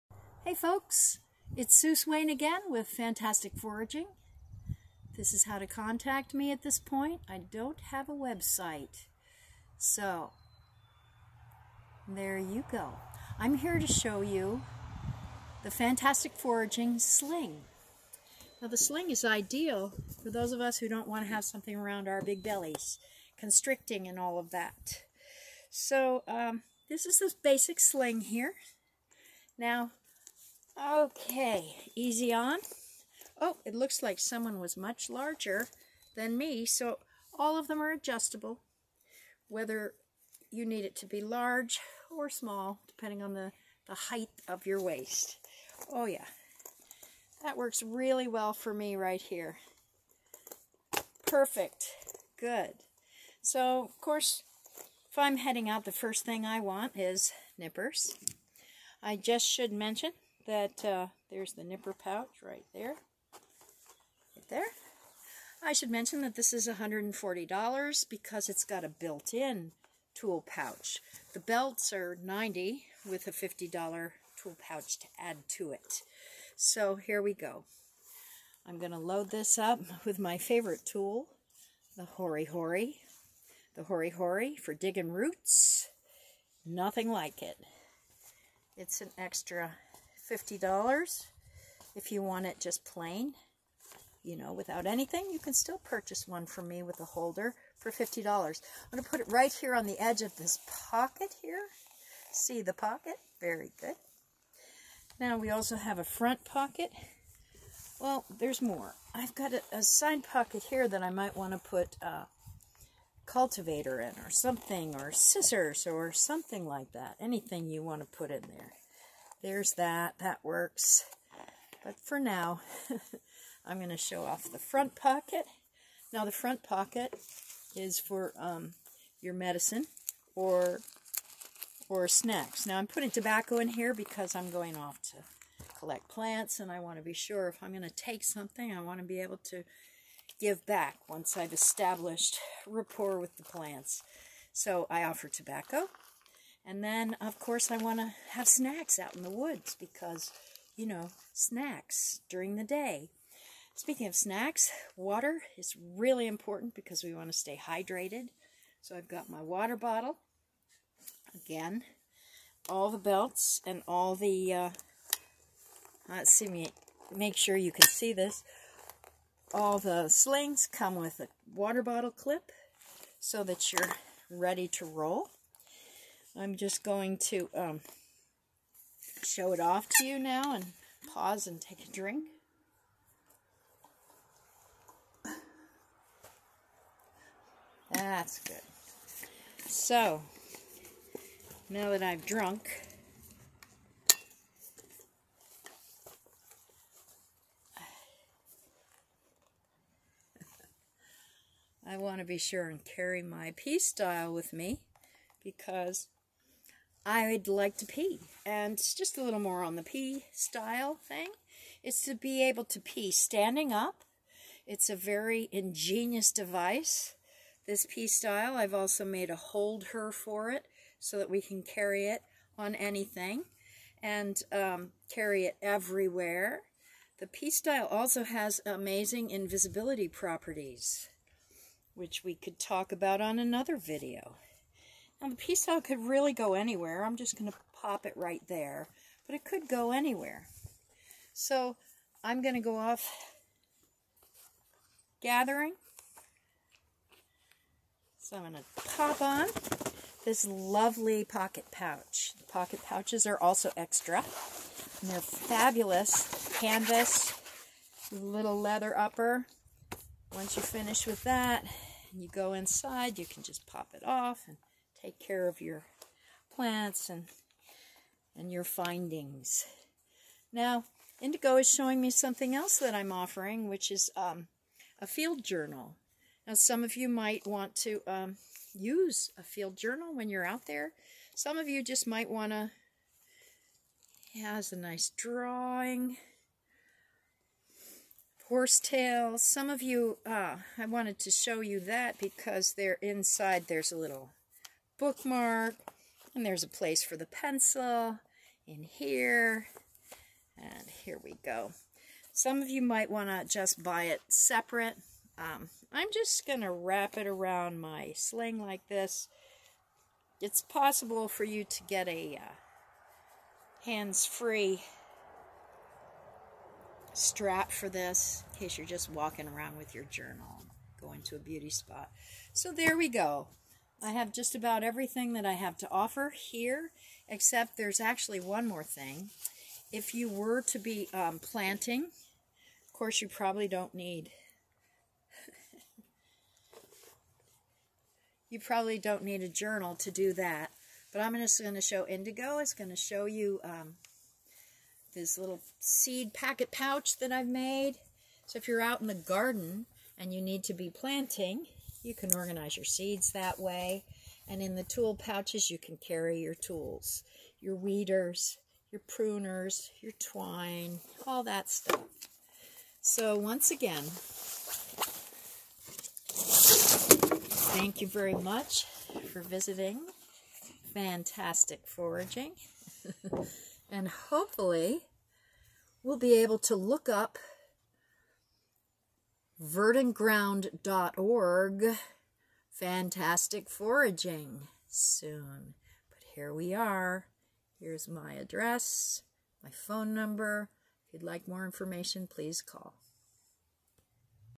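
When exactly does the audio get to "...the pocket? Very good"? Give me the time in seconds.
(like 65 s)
102 s.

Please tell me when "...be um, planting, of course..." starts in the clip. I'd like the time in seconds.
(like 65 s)
330 s.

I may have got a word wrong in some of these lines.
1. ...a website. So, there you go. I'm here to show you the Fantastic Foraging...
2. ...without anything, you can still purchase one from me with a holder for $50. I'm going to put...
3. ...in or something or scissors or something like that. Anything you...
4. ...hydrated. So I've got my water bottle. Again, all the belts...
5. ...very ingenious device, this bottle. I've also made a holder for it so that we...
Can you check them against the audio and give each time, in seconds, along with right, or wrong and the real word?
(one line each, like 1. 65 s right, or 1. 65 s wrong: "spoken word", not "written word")
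1. 8 s right
2. 94 s right
3. 113 s right
4. 157 s right
5. 214 s wrong: "pStyle", not "bottle".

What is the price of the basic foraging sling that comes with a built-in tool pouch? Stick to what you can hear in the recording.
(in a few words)
$140.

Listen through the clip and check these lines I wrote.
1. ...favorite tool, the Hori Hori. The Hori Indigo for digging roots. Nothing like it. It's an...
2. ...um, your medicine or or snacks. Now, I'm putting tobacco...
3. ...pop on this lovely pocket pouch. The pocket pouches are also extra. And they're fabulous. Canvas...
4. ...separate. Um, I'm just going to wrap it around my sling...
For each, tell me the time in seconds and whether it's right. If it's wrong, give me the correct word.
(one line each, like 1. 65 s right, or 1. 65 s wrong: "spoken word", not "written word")
1. 80 s wrong: "Hori", not "Indigo"
2. 128 s right
3. 248 s right
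4. 304 s right.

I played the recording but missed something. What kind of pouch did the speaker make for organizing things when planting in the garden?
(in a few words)
Seed packet pouch.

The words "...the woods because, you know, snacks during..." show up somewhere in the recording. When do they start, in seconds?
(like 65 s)
149 s.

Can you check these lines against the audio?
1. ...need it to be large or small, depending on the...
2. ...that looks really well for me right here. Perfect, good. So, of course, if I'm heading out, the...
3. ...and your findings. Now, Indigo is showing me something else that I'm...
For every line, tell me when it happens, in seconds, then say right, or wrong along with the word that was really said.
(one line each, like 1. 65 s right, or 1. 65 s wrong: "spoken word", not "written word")
1. 40 s right
2. 47 s wrong: "works", not "looks"
3. 268 s right.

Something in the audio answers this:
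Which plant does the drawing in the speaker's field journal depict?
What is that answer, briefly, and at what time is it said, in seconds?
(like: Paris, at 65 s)
Horsetail, at 288 s.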